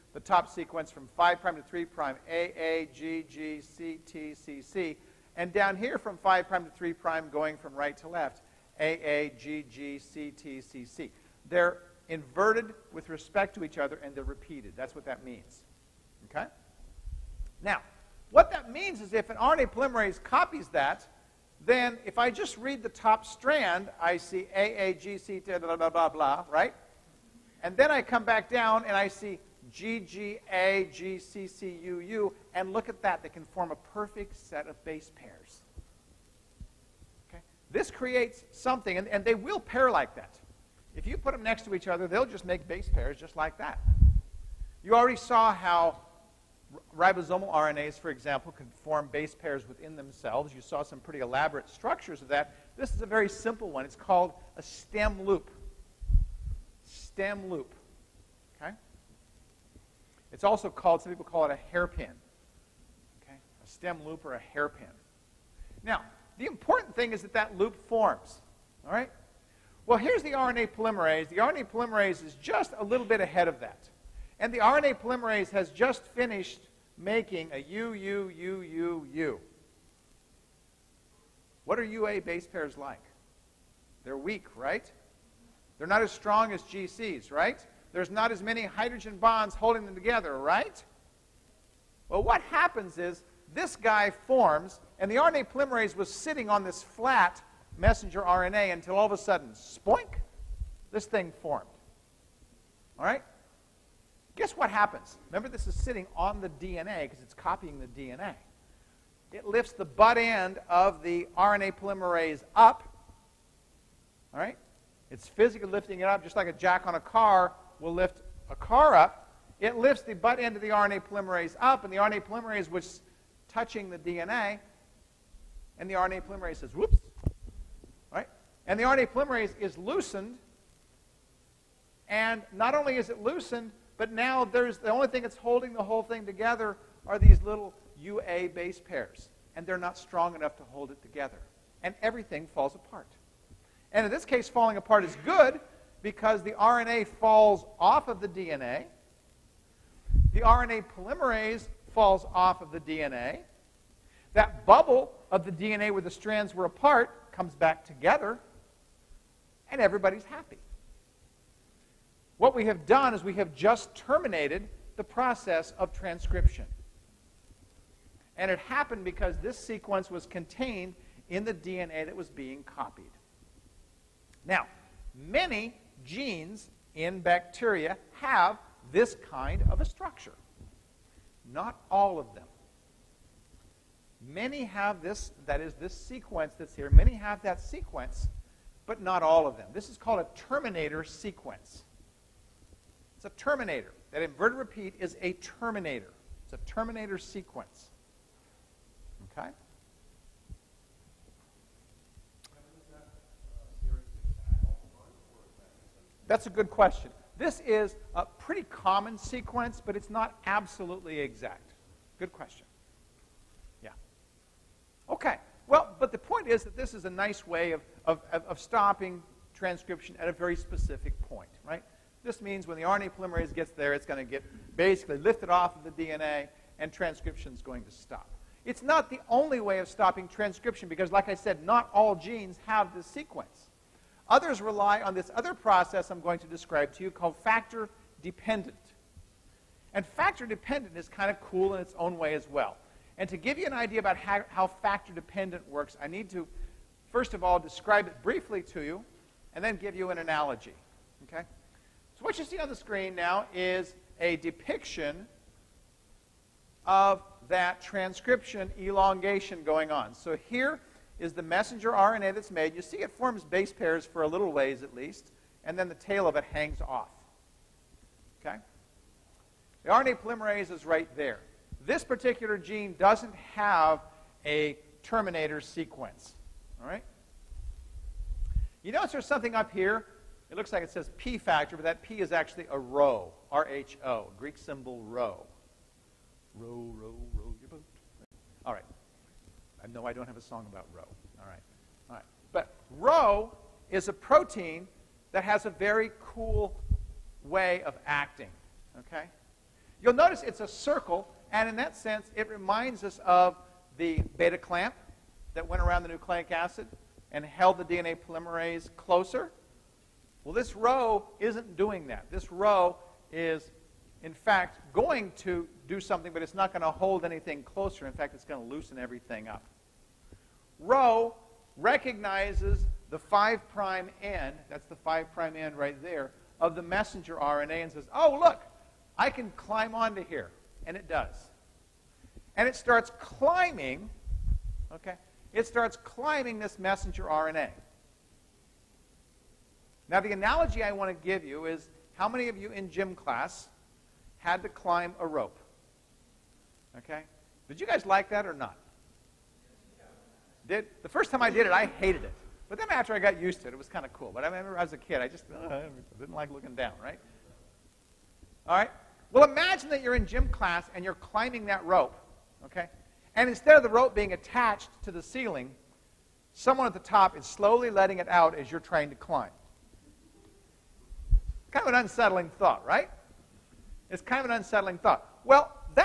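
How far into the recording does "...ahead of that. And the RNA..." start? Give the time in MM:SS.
01:13.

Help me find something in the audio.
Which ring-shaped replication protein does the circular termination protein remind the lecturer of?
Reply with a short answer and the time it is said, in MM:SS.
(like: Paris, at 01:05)
beta clamp, at 05:04.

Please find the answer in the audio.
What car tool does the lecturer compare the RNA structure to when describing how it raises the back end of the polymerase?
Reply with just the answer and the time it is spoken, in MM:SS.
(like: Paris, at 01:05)
a jack, at 01:56.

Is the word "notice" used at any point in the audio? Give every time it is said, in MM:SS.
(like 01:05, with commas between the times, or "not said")
04:38, 05:00.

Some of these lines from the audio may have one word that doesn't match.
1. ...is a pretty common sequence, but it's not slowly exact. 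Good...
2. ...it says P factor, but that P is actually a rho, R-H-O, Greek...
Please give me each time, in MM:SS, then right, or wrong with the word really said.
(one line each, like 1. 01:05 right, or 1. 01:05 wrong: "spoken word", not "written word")
1. 03:27 wrong: "absolutely", not "slowly"
2. 04:40 right.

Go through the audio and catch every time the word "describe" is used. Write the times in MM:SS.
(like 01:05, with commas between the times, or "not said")
03:56, 04:07.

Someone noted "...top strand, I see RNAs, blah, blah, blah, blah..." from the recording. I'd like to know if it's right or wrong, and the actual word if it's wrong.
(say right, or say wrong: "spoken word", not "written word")
wrong: "AAGC", not "RNAs".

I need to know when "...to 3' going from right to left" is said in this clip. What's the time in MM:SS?
00:06.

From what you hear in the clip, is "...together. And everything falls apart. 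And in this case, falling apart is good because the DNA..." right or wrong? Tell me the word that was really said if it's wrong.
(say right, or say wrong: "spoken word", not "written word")
wrong: "RNA", not "DNA".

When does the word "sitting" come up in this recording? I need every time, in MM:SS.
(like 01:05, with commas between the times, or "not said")
01:36, 01:45.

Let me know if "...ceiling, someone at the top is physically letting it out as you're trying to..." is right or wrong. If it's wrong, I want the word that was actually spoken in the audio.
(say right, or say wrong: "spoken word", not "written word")
wrong: "slowly", not "physically".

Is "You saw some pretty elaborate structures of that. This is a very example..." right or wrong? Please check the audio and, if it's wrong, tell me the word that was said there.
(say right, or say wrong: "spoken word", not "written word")
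wrong: "simple", not "example".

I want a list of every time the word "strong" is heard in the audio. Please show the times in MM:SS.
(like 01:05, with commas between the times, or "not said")
01:26, 02:19.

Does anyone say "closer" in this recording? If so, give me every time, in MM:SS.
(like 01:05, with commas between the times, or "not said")
05:08, 05:17.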